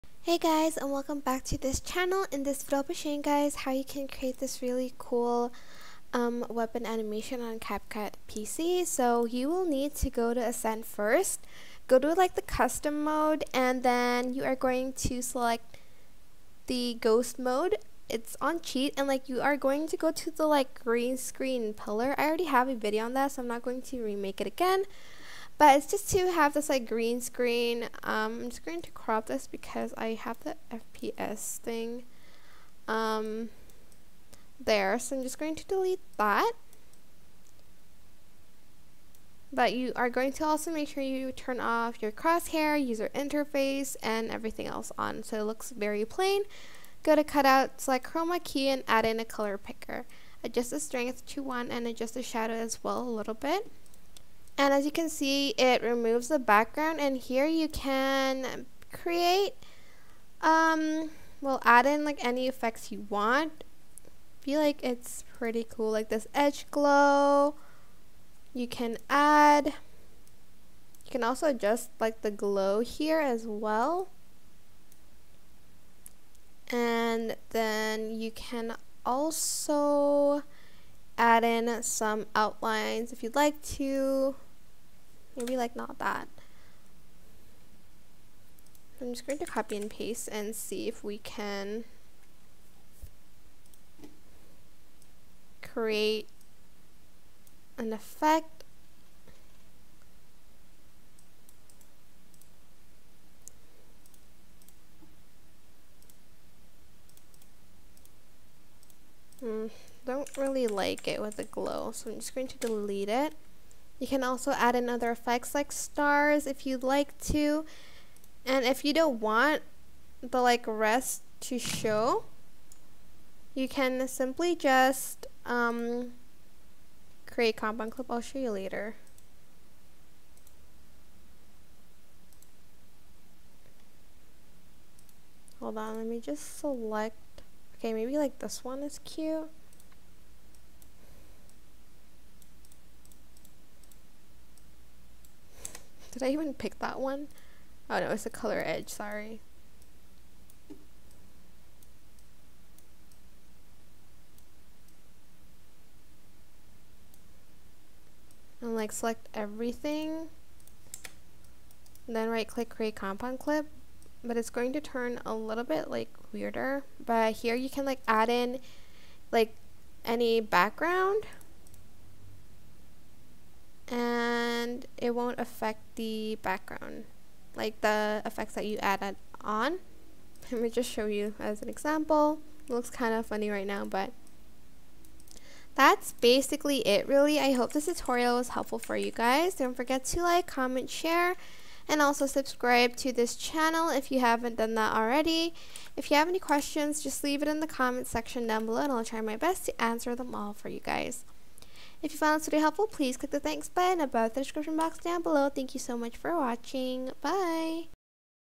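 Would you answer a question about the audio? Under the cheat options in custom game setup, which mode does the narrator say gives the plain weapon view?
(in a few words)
ghost mode.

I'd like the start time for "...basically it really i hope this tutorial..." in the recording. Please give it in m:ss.
3:06.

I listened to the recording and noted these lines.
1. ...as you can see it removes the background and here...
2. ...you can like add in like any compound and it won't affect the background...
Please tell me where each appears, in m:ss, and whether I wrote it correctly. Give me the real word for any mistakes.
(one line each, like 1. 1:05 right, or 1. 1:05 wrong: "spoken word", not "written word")
1. 0:54 right
2. 2:47 wrong: "background", not "compound".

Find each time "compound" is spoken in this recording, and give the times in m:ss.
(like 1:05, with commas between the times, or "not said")
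2:07, 2:42.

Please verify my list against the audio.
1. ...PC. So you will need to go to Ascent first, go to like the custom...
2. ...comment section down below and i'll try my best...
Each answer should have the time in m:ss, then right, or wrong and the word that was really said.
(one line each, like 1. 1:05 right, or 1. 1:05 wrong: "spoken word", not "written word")
1. 0:08 right
2. 3:17 right.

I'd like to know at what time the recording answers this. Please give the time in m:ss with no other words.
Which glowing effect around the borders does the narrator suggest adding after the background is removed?
1:06.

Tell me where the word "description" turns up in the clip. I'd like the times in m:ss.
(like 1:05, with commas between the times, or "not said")
3:24.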